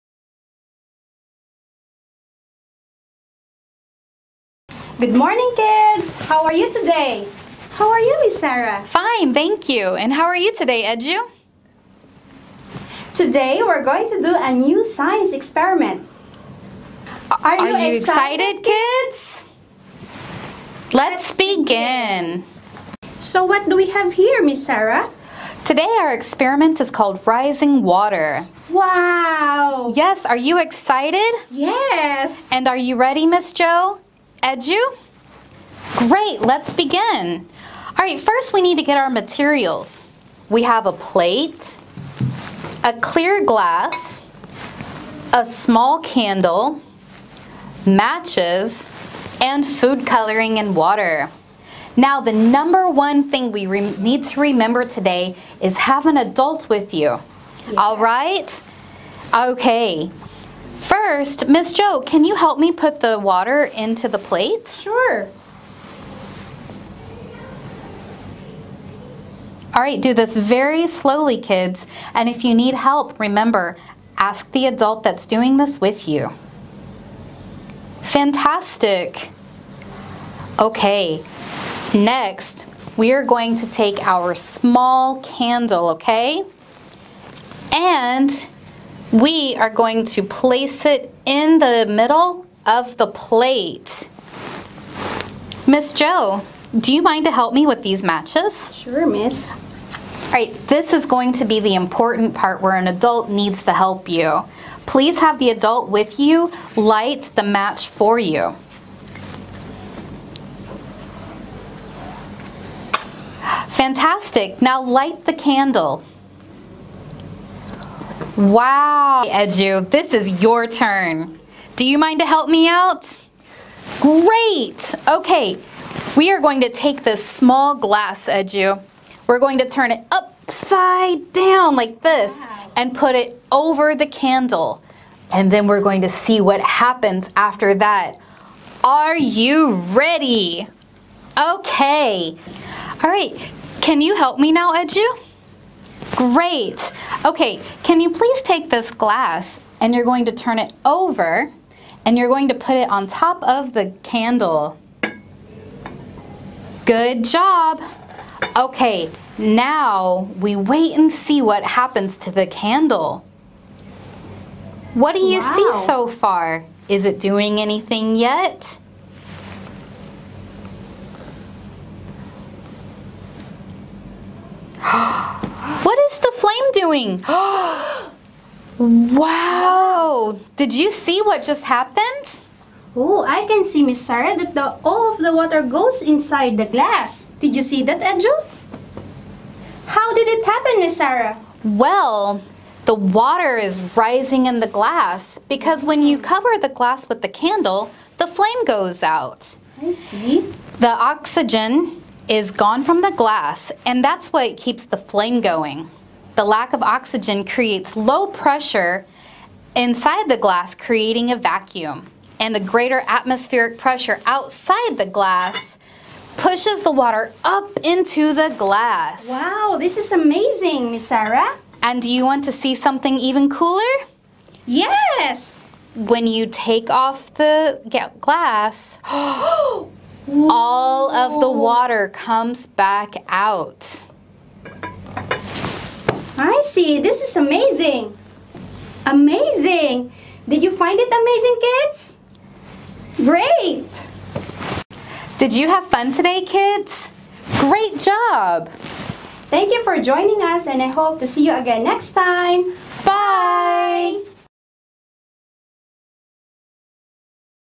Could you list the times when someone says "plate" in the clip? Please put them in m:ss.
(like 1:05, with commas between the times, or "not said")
0:40, 1:04, 1:33.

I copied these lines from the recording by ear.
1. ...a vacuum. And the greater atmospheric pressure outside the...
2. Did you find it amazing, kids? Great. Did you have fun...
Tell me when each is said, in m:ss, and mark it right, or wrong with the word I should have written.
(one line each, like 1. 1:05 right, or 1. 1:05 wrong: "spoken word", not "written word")
1. 3:31 right
2. 4:00 right.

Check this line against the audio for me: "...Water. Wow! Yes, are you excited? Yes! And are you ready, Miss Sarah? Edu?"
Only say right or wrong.
wrong.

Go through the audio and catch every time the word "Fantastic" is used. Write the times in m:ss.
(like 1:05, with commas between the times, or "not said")
1:18, 1:53.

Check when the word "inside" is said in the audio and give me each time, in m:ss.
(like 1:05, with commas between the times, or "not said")
3:06, 3:29.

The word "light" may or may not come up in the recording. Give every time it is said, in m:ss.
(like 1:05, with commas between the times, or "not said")
1:46, 1:54.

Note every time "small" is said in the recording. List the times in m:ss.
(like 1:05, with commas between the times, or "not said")
0:45, 1:24, 2:07.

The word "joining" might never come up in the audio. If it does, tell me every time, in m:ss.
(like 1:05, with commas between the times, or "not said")
4:10.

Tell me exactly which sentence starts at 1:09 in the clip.
All right, do this very slowly, kids.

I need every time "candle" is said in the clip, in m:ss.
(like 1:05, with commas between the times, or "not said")
0:45, 1:25, 1:55, 2:14, 2:34, 2:42, 3:17.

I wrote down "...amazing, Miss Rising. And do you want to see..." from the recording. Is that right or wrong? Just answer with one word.
wrong.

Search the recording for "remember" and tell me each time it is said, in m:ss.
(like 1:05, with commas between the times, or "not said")
0:54, 1:13.